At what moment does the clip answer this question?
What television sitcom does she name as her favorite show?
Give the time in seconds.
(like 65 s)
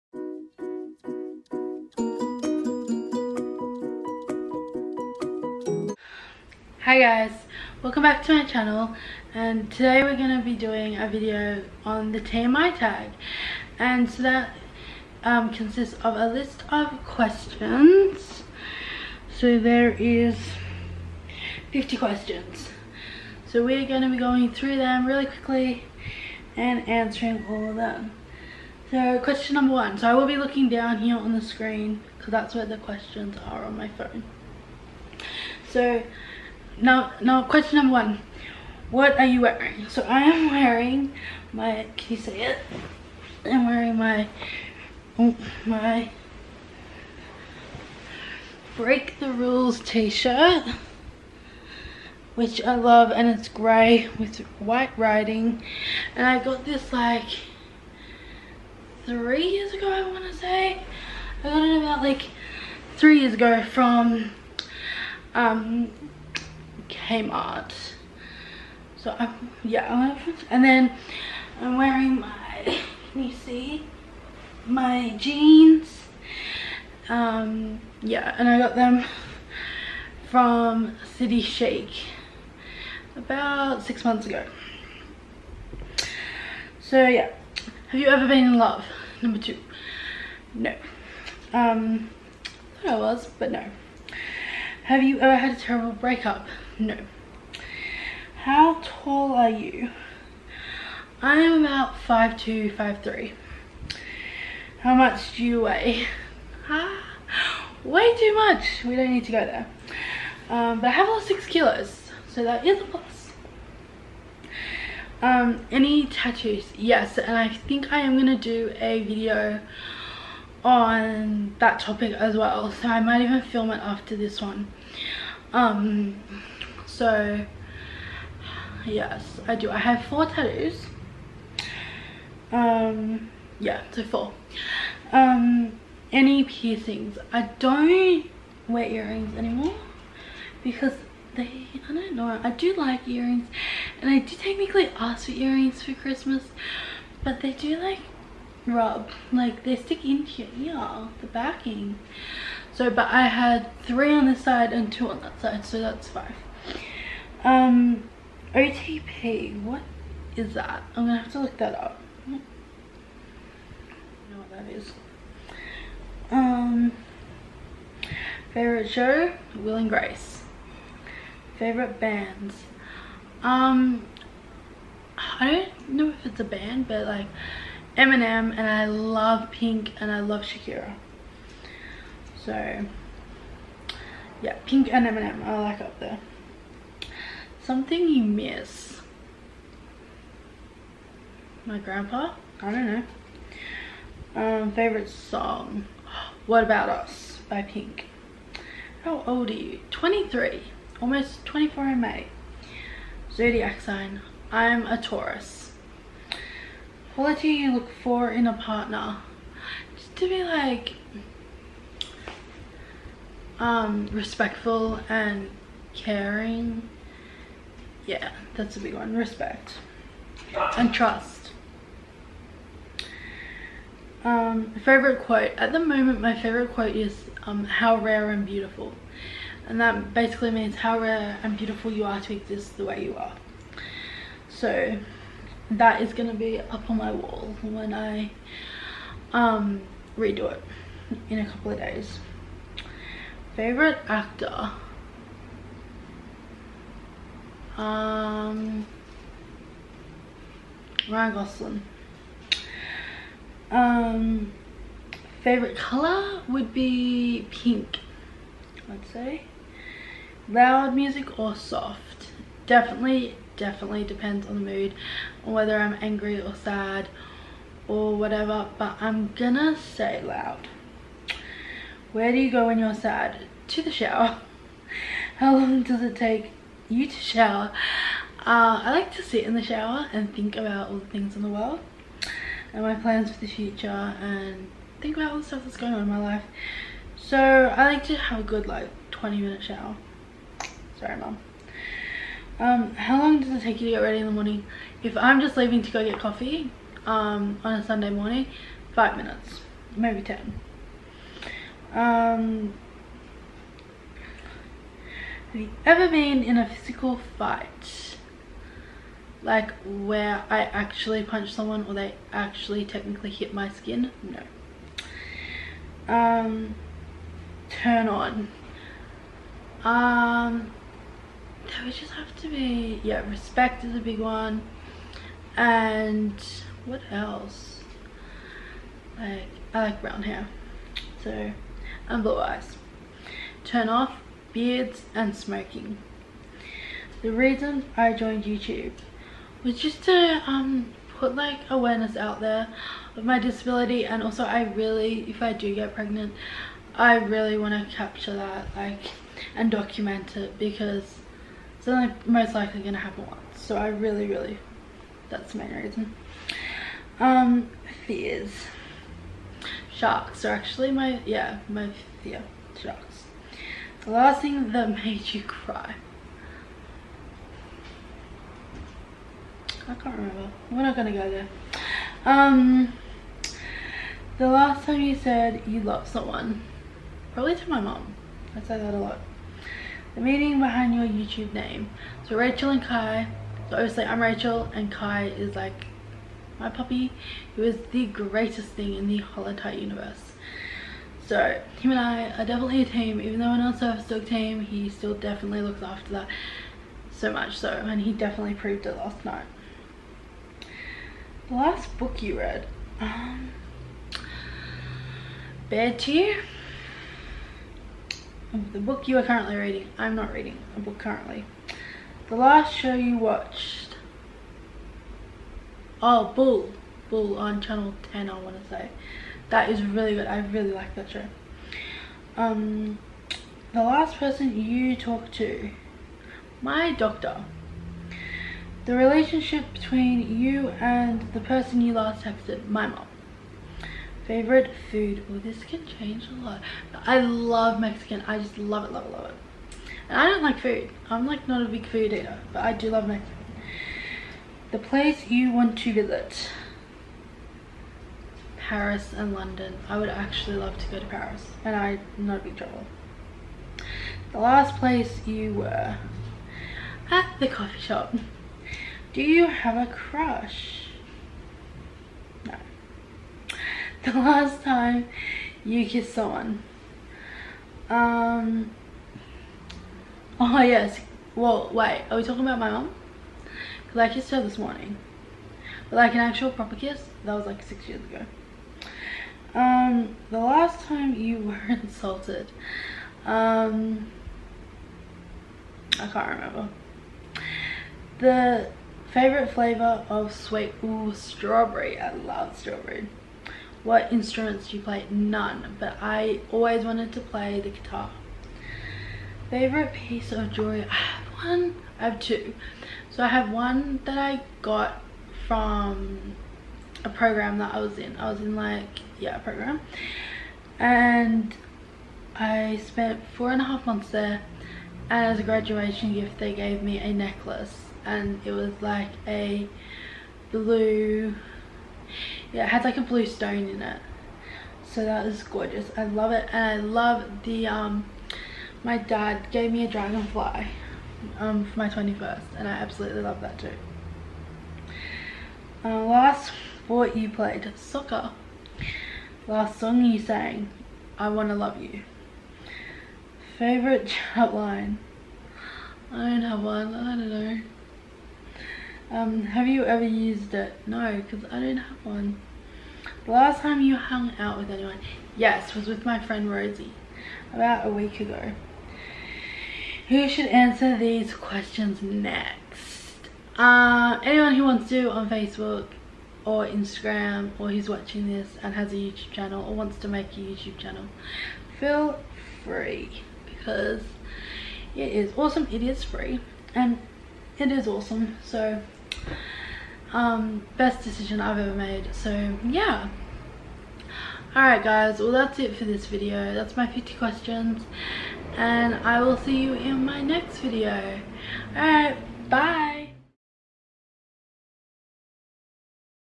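169 s.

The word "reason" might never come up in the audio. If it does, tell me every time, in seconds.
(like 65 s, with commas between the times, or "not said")
337 s, 355 s.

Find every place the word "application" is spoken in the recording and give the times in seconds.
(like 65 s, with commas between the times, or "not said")
not said.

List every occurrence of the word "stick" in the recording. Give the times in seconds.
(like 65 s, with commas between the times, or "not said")
149 s.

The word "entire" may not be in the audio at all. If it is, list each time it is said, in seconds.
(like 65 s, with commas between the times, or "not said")
389 s.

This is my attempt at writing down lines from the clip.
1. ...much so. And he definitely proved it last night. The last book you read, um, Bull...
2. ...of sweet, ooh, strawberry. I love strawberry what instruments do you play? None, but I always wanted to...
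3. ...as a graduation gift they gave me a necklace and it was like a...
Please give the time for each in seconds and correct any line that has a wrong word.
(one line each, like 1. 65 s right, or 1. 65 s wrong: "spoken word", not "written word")
1. 397 s wrong: "Bear", not "Bull"
2. 490 s right
3. 515 s right.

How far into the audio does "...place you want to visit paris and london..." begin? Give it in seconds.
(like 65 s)
444 s.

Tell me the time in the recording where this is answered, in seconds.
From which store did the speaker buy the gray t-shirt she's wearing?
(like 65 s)
67 s.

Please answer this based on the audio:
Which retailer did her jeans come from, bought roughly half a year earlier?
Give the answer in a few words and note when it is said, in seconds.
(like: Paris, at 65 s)
City Chic, at 81 s.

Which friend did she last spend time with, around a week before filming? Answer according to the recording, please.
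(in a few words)
Rosie.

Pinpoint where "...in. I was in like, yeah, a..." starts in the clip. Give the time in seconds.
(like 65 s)
507 s.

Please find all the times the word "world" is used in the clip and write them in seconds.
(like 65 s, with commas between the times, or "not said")
281 s.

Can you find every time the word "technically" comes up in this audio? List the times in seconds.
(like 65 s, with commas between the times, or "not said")
144 s, 312 s.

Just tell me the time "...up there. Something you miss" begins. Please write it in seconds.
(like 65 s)
185 s.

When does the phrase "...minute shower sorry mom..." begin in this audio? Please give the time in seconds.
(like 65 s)
289 s.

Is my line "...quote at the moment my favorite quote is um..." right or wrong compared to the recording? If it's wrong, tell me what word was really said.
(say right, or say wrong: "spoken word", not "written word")
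right.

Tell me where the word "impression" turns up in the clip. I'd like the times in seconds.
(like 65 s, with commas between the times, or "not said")
not said.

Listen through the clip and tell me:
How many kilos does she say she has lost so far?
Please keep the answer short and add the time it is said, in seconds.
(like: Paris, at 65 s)
6, at 111 s.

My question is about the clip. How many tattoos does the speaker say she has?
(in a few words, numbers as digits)
4.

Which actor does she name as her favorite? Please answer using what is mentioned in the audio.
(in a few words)
Ryan Gosling.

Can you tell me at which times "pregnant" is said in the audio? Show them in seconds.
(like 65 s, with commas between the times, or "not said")
345 s.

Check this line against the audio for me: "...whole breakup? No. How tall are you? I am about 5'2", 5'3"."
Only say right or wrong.
wrong.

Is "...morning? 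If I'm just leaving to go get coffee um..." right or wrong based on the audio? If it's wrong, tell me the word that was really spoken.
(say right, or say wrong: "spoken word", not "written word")
right.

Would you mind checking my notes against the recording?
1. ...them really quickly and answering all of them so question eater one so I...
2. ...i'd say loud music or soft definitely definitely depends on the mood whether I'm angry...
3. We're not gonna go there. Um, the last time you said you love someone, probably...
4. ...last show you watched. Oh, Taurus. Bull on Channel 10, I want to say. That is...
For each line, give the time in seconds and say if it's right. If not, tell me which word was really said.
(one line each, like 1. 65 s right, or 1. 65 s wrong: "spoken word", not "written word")
1. 24 s wrong: "number", not "eater"
2. 258 s right
3. 370 s right
4. 412 s wrong: "Bull", not "Taurus".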